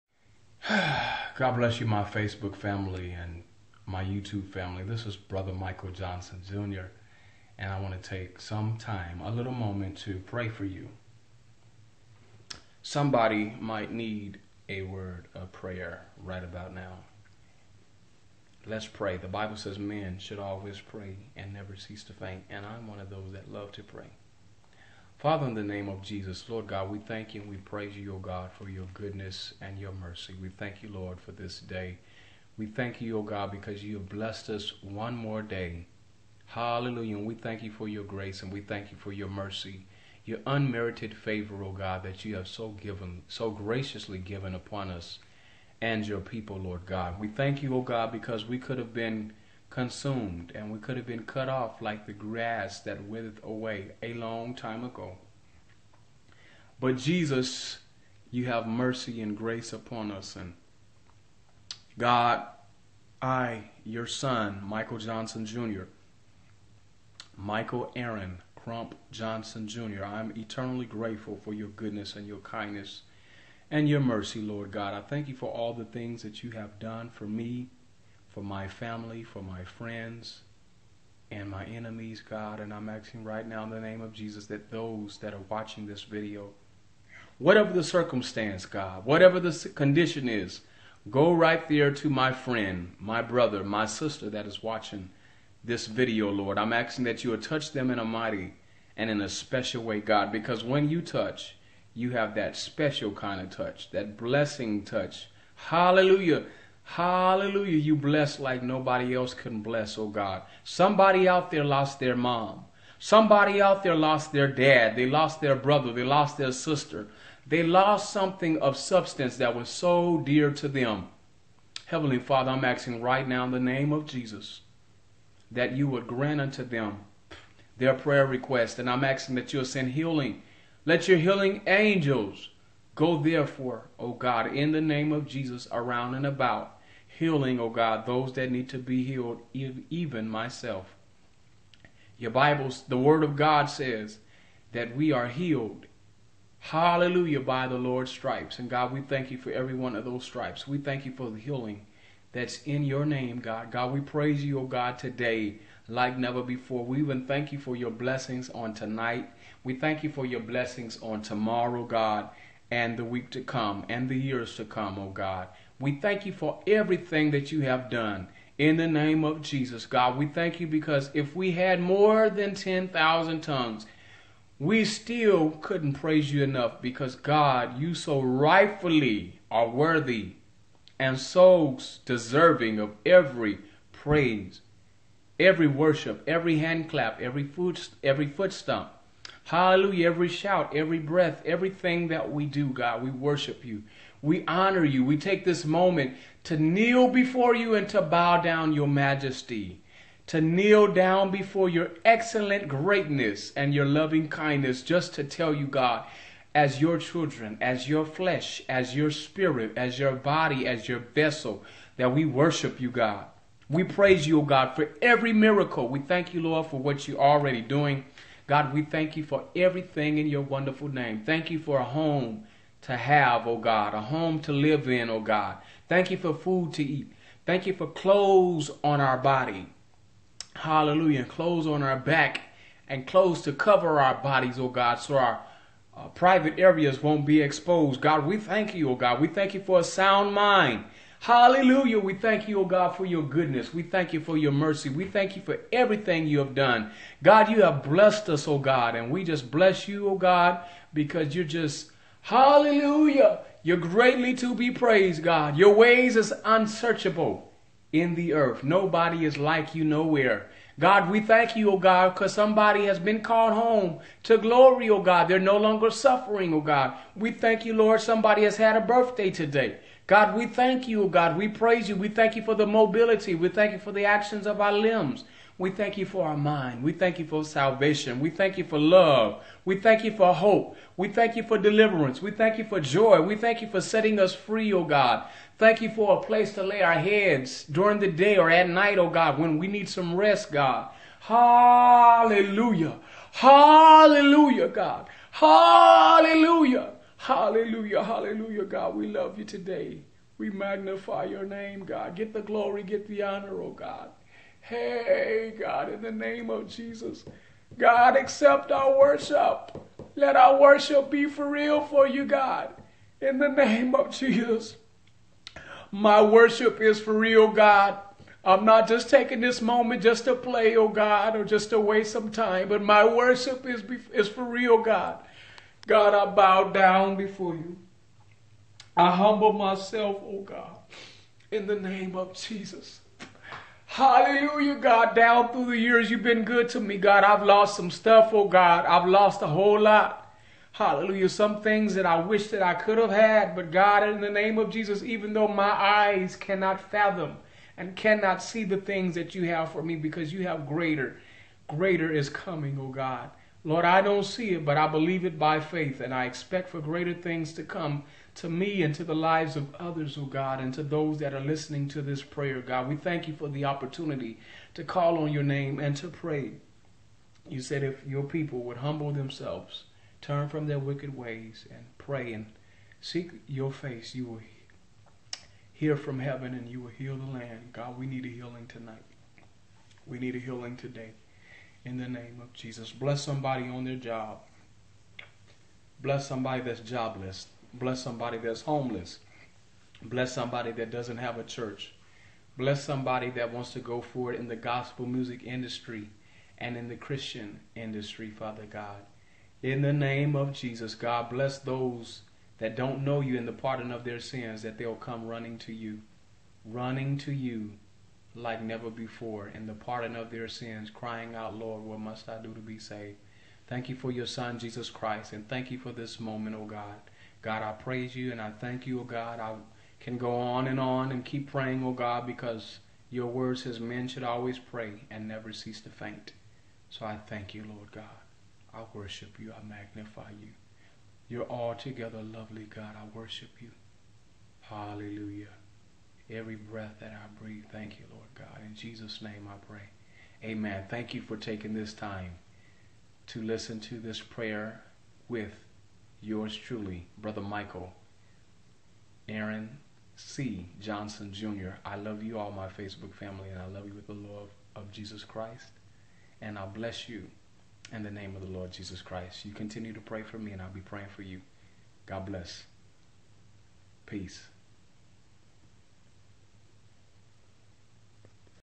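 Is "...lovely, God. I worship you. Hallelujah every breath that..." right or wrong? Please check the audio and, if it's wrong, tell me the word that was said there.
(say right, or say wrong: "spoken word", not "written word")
right.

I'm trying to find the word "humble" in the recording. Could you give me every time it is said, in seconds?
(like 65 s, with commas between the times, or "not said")
329 s, 368 s.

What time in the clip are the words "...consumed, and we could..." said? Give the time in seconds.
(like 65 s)
49 s.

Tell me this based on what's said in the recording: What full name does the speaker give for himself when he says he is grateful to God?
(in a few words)
Michael Aaron Crump Johnson Jr.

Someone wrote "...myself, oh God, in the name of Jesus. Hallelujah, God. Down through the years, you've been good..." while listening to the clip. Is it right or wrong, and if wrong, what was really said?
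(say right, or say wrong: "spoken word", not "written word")
right.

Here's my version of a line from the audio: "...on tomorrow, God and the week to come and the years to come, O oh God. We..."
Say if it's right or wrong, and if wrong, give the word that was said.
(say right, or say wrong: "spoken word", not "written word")
right.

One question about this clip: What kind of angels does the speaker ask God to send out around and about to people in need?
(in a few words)
Healing angels.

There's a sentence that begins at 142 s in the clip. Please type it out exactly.
Your Bible, the Word of God says that we are healed.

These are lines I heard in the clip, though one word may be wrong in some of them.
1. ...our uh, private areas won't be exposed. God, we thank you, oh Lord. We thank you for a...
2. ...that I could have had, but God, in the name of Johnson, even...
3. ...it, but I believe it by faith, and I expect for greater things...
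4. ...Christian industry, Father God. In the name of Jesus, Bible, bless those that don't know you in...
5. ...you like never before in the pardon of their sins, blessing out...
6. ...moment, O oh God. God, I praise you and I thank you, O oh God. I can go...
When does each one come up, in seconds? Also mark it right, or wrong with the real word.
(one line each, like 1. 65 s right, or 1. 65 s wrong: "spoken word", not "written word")
1. 235 s wrong: "God", not "Lord"
2. 342 s wrong: "Jesus", not "Johnson"
3. 354 s right
4. 396 s wrong: "God", not "Bible"
5. 407 s wrong: "crying", not "blessing"
6. 416 s right.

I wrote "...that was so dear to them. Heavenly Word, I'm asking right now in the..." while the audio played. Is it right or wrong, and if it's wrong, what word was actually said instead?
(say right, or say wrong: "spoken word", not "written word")
wrong: "Father", not "Word".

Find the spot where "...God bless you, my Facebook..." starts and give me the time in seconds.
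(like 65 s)
1 s.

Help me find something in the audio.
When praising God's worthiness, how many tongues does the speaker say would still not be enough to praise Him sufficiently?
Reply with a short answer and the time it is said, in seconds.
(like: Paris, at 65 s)
10,000, at 172 s.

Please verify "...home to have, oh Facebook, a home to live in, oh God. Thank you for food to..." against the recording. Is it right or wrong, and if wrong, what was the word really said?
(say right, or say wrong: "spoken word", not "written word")
wrong: "God", not "Facebook".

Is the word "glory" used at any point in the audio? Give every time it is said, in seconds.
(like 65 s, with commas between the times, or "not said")
264 s, 302 s.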